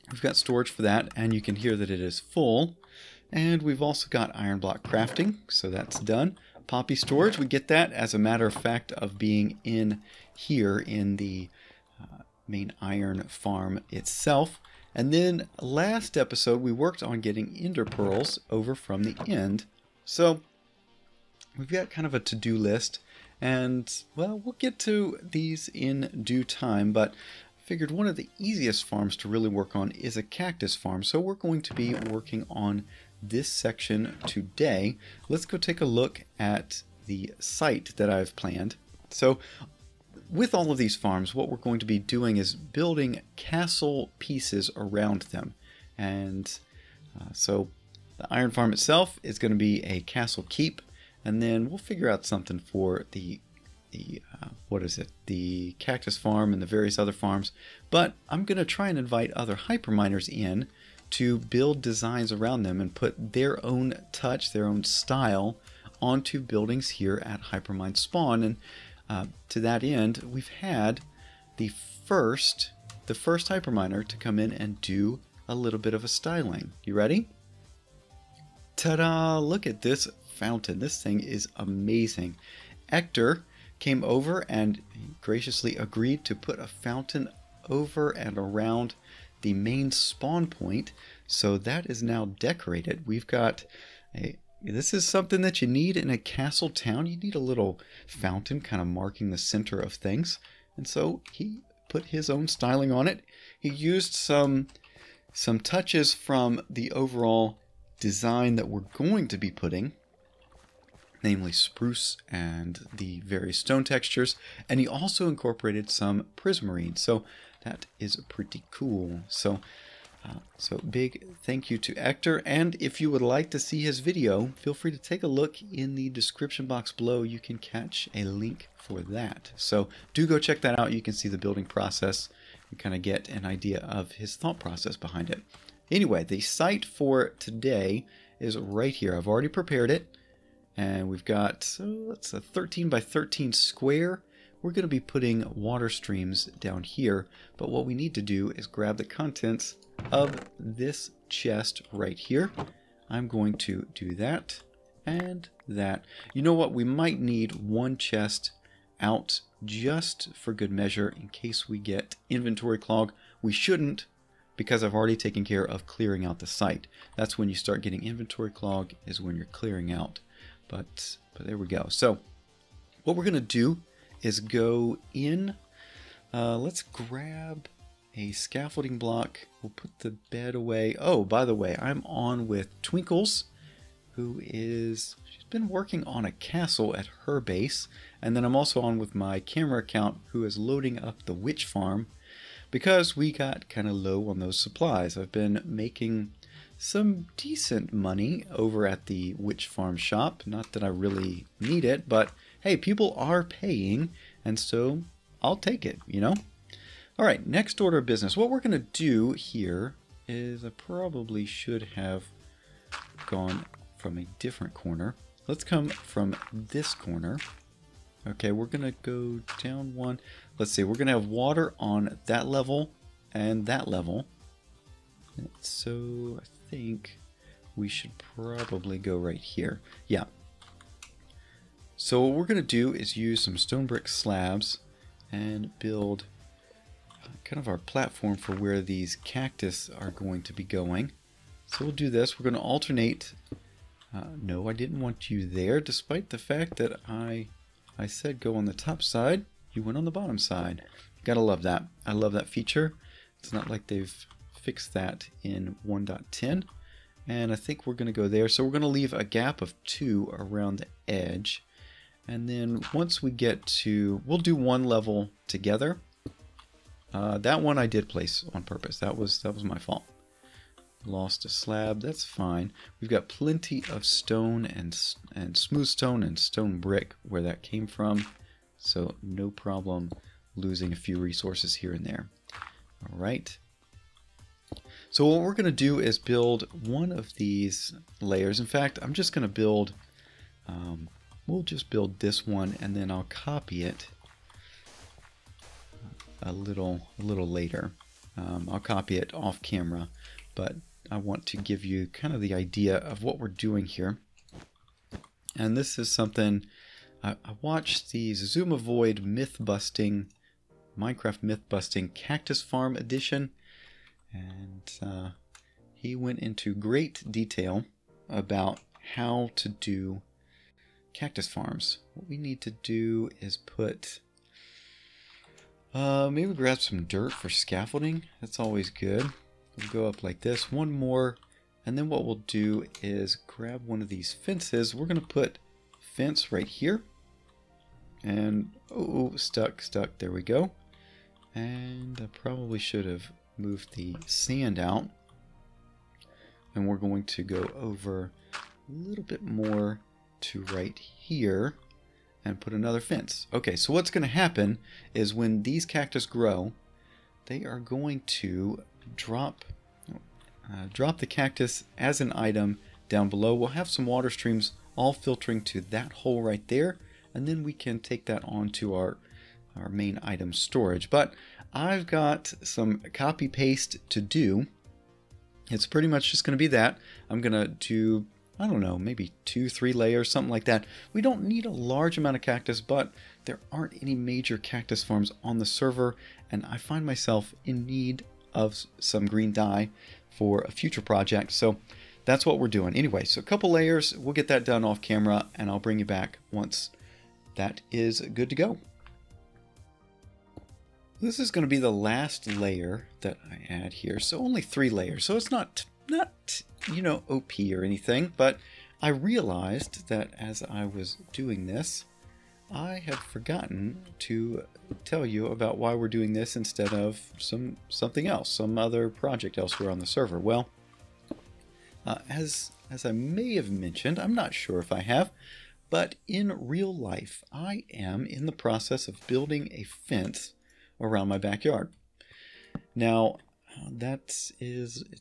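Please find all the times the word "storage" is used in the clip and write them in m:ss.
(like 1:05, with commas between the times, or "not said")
0:00, 0:06, 6:10.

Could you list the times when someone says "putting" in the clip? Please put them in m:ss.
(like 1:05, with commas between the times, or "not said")
1:49, 2:24.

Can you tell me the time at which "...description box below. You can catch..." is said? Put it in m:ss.
2:06.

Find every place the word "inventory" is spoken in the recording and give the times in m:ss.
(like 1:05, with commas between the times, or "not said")
2:42, 2:48.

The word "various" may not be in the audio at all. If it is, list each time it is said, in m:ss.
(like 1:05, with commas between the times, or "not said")
0:56, 1:53.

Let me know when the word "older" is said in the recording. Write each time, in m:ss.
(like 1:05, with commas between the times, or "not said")
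not said.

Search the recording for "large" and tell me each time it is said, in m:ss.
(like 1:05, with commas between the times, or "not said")
6:21.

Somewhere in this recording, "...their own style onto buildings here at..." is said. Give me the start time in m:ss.
1:04.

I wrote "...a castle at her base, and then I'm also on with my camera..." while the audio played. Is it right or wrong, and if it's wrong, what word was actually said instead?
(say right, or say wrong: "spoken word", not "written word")
right.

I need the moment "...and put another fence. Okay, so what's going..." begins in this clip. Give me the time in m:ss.
5:52.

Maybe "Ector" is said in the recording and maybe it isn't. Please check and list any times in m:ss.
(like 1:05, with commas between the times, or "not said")
1:22, 2:01.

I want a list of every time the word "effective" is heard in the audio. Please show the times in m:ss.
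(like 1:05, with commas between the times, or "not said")
not said.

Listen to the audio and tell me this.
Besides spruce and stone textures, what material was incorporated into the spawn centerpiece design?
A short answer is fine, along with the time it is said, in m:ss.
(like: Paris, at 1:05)
prismarine, at 1:56.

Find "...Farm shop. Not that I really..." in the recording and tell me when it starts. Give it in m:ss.
3:19.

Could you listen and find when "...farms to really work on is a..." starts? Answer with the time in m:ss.
0:28.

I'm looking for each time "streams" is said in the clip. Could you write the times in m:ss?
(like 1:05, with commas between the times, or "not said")
2:25, 6:04.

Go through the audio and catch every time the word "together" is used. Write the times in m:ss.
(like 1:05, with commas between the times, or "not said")
4:25.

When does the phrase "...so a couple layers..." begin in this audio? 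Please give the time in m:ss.
6:33.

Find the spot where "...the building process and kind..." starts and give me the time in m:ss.
2:11.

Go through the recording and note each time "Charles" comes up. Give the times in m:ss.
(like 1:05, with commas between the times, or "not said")
not said.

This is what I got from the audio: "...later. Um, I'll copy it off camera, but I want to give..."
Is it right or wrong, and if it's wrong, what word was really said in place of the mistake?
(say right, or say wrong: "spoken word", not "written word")
right.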